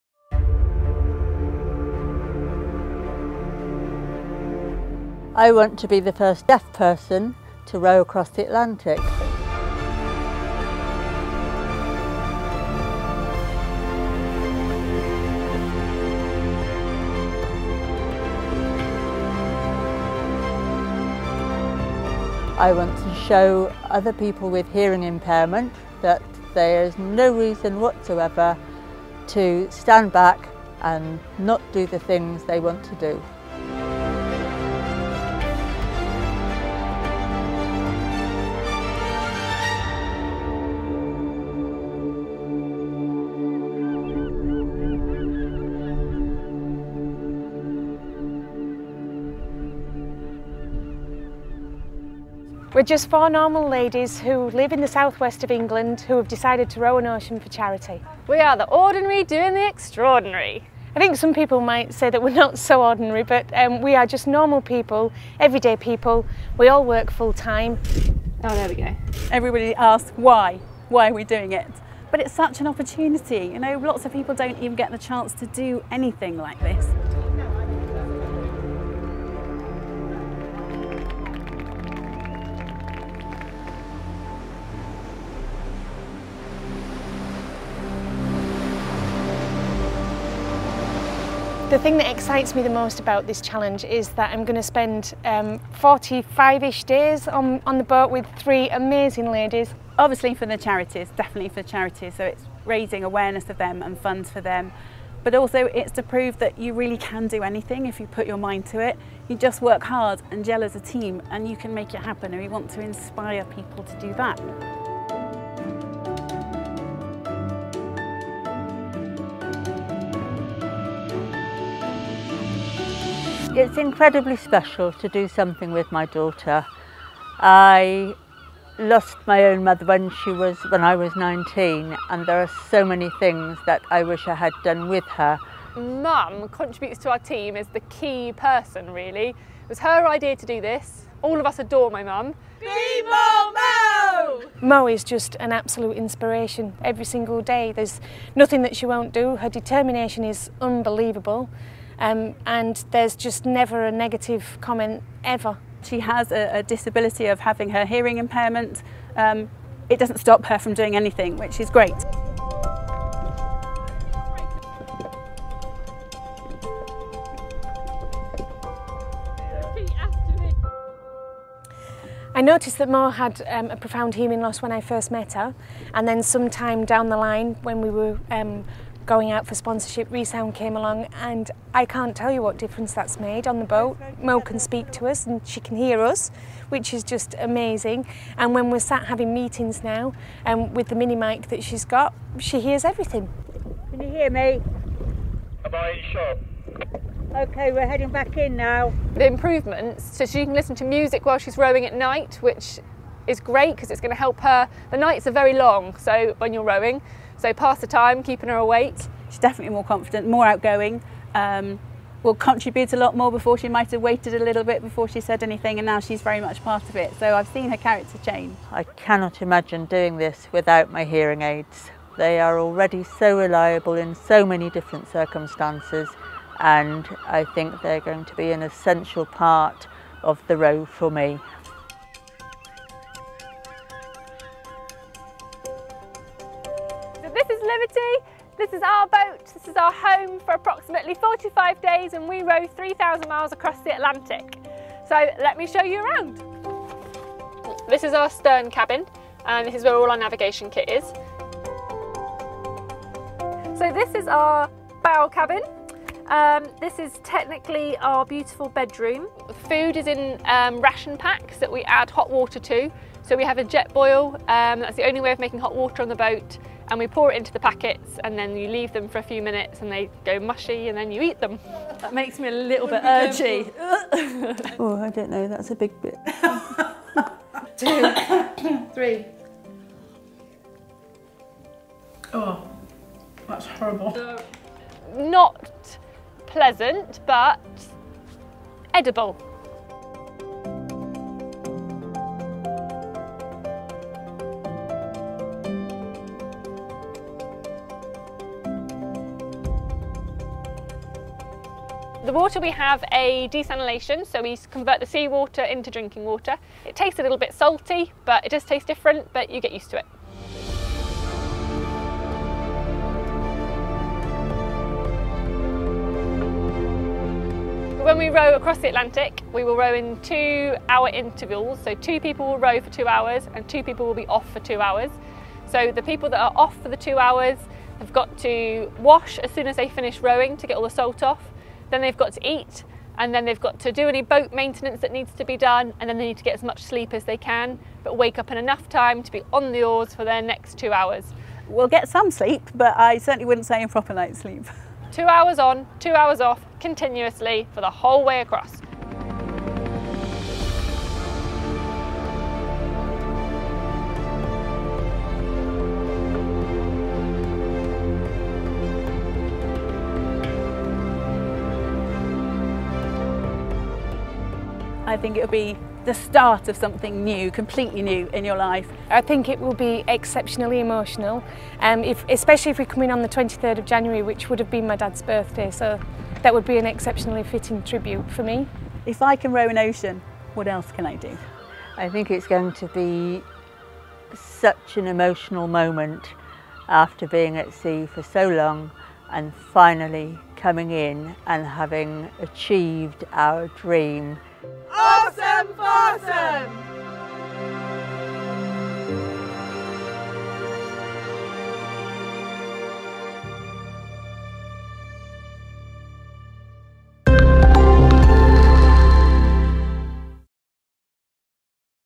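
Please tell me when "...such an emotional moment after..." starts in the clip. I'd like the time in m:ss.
6:24.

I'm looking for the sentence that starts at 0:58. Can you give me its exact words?
We are the ordinary doing the extraordinary.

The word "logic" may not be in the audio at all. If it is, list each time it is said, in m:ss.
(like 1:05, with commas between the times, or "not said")
not said.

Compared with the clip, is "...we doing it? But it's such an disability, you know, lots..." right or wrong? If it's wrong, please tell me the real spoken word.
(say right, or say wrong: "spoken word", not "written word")
wrong: "opportunity", not "disability".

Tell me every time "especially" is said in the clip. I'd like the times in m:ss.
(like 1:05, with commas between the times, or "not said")
6:12.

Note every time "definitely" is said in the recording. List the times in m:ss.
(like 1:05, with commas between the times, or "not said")
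1:41, 3:29.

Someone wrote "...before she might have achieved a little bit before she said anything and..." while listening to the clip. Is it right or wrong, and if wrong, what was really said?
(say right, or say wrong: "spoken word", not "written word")
wrong: "waited", not "achieved".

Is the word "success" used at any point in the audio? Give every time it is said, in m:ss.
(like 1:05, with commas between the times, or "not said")
not said.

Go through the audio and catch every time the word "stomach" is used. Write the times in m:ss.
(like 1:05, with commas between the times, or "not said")
not said.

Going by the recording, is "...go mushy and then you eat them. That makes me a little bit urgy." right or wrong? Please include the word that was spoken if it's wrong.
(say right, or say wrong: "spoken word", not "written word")
right.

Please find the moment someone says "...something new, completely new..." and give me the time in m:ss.
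6:06.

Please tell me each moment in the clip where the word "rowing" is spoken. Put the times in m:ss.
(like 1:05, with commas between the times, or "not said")
3:21, 3:26, 5:30.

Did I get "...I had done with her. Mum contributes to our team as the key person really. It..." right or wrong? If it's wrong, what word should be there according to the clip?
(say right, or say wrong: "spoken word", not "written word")
right.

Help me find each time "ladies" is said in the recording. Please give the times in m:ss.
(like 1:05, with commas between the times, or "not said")
0:53, 1:39.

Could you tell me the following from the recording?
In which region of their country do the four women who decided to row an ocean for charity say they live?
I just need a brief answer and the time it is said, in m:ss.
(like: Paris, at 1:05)
Southwest of England, at 0:54.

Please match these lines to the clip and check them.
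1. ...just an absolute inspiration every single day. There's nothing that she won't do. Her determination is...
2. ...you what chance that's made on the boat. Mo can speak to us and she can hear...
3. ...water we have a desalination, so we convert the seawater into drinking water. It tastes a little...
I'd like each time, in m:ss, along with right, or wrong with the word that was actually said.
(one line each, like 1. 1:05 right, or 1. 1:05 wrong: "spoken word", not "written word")
1. 2:25 right
2. 3:02 wrong: "difference", not "chance"
3. 5:02 right.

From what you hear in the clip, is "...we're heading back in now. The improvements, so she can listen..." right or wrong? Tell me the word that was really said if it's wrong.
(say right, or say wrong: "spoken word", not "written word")
right.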